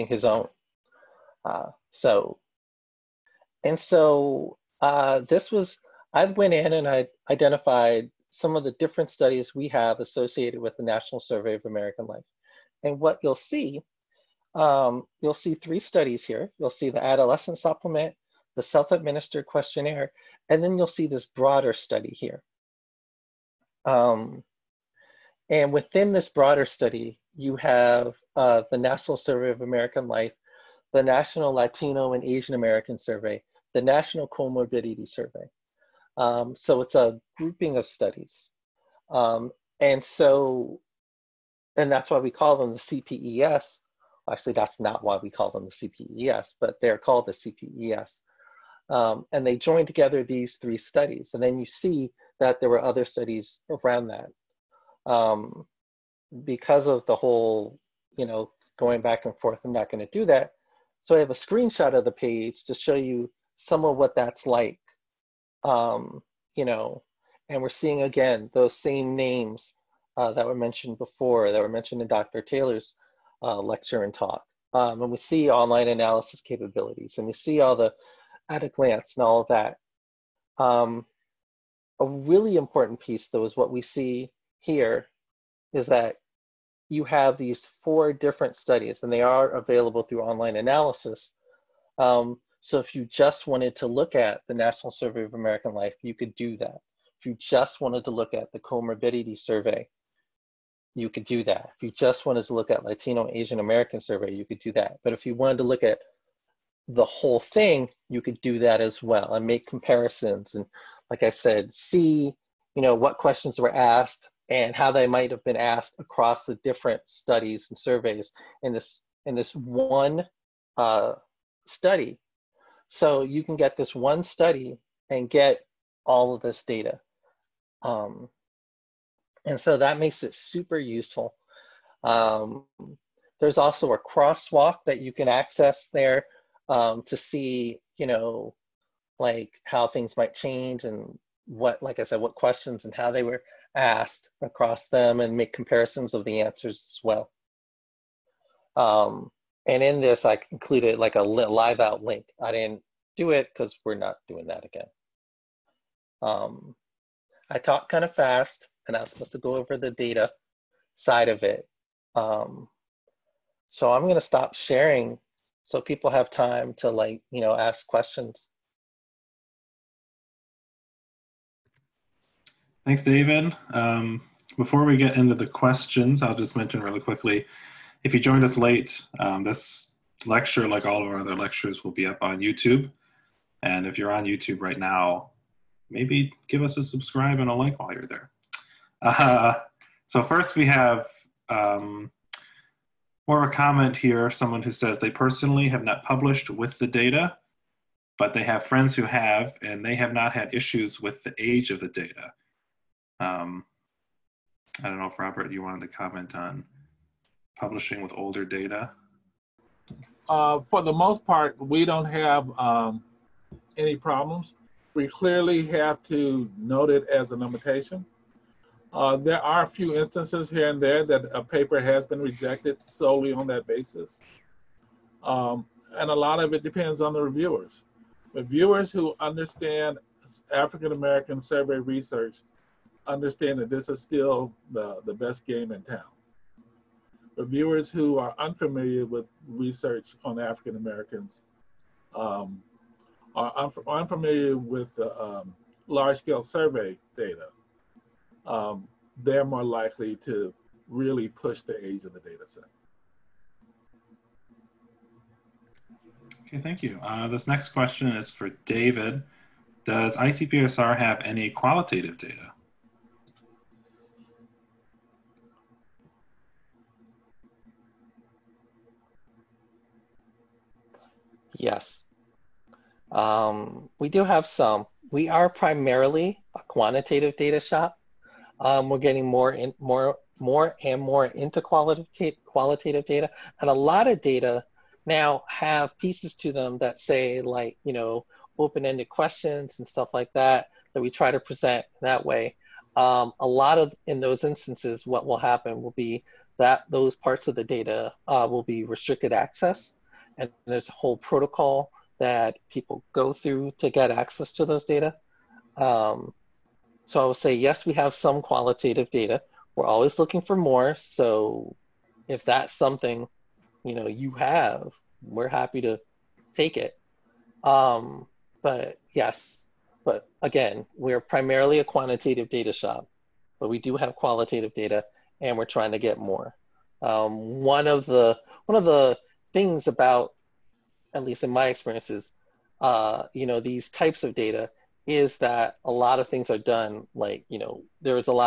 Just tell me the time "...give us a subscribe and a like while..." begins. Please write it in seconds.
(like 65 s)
186 s.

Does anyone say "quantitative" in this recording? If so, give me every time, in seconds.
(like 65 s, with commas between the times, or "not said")
276 s, 321 s.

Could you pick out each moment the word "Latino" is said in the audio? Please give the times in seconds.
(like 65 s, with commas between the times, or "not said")
31 s, 102 s.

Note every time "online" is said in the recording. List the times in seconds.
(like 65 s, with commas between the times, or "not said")
75 s, 90 s.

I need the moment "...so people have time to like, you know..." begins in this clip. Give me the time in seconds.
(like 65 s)
165 s.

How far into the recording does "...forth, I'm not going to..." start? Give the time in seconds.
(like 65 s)
59 s.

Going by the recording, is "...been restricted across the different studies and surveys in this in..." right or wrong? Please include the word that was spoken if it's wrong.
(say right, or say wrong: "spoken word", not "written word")
wrong: "asked", not "restricted".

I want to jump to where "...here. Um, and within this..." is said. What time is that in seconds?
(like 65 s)
22 s.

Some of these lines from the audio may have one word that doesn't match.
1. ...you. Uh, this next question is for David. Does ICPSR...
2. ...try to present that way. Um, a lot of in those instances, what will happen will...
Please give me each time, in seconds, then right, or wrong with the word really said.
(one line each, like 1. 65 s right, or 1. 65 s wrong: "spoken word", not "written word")
1. 256 s right
2. 291 s right.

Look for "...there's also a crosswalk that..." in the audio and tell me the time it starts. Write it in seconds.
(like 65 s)
133 s.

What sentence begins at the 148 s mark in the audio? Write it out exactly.
Um, and in this, I included like a live out link.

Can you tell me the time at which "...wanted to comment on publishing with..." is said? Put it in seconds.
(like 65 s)
205 s.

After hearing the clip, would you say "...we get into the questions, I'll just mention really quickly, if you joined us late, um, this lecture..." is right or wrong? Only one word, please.
right.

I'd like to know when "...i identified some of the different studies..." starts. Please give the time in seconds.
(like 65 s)
6 s.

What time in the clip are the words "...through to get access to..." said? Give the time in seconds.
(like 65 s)
303 s.